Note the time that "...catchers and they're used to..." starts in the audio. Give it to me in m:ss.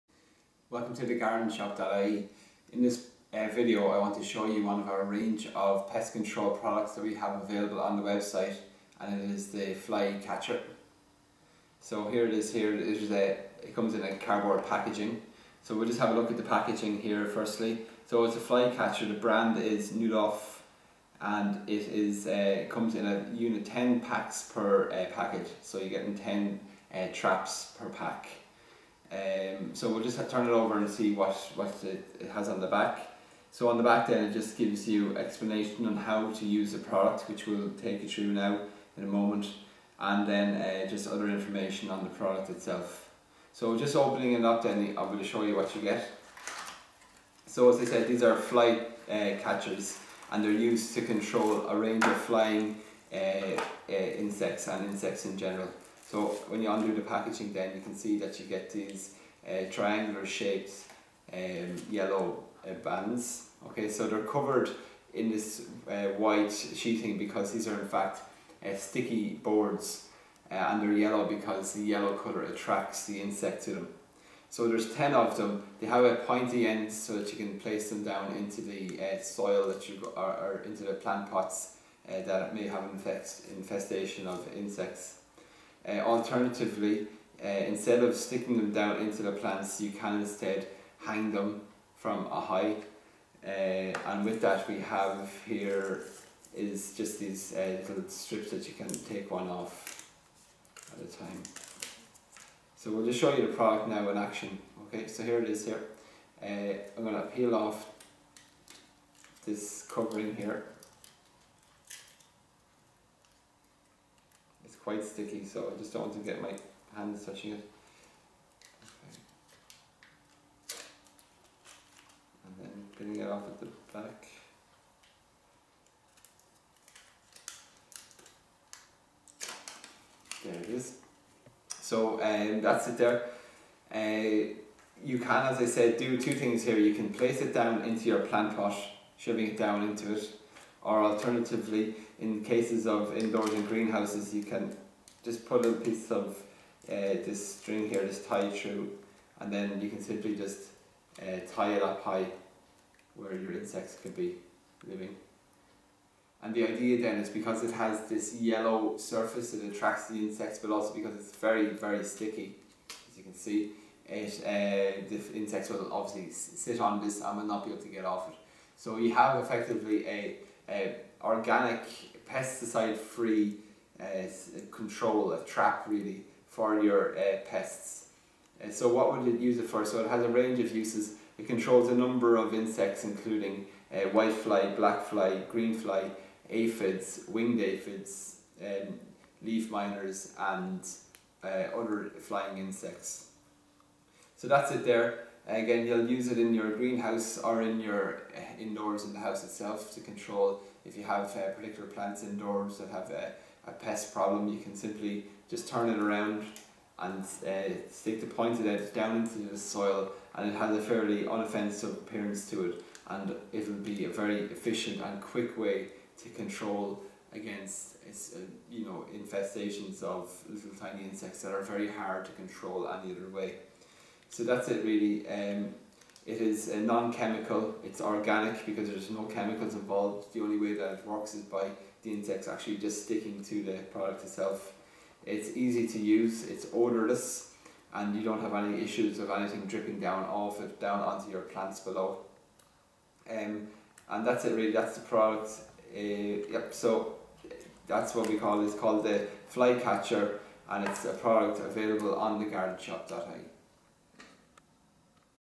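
0:49.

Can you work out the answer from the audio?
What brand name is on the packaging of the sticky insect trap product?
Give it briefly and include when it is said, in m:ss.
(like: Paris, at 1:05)
Neudorff, at 0:19.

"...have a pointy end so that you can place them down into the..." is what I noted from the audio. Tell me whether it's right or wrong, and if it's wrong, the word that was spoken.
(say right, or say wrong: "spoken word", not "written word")
right.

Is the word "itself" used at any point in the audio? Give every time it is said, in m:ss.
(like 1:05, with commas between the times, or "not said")
0:42, 3:19, 3:54.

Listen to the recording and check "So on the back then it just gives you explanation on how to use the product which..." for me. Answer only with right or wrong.
right.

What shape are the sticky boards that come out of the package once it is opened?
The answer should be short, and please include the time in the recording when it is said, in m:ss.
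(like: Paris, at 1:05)
Triangular, at 0:59.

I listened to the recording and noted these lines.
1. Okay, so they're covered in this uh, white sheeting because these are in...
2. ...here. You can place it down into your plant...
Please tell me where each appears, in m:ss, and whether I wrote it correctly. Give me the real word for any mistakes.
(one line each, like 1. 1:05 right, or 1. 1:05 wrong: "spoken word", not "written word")
1. 1:03 right
2. 2:16 right.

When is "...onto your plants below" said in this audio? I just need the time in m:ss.
4:01.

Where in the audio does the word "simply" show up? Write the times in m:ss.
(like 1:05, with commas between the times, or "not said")
2:30, 3:24.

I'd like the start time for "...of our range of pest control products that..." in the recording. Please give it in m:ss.
0:04.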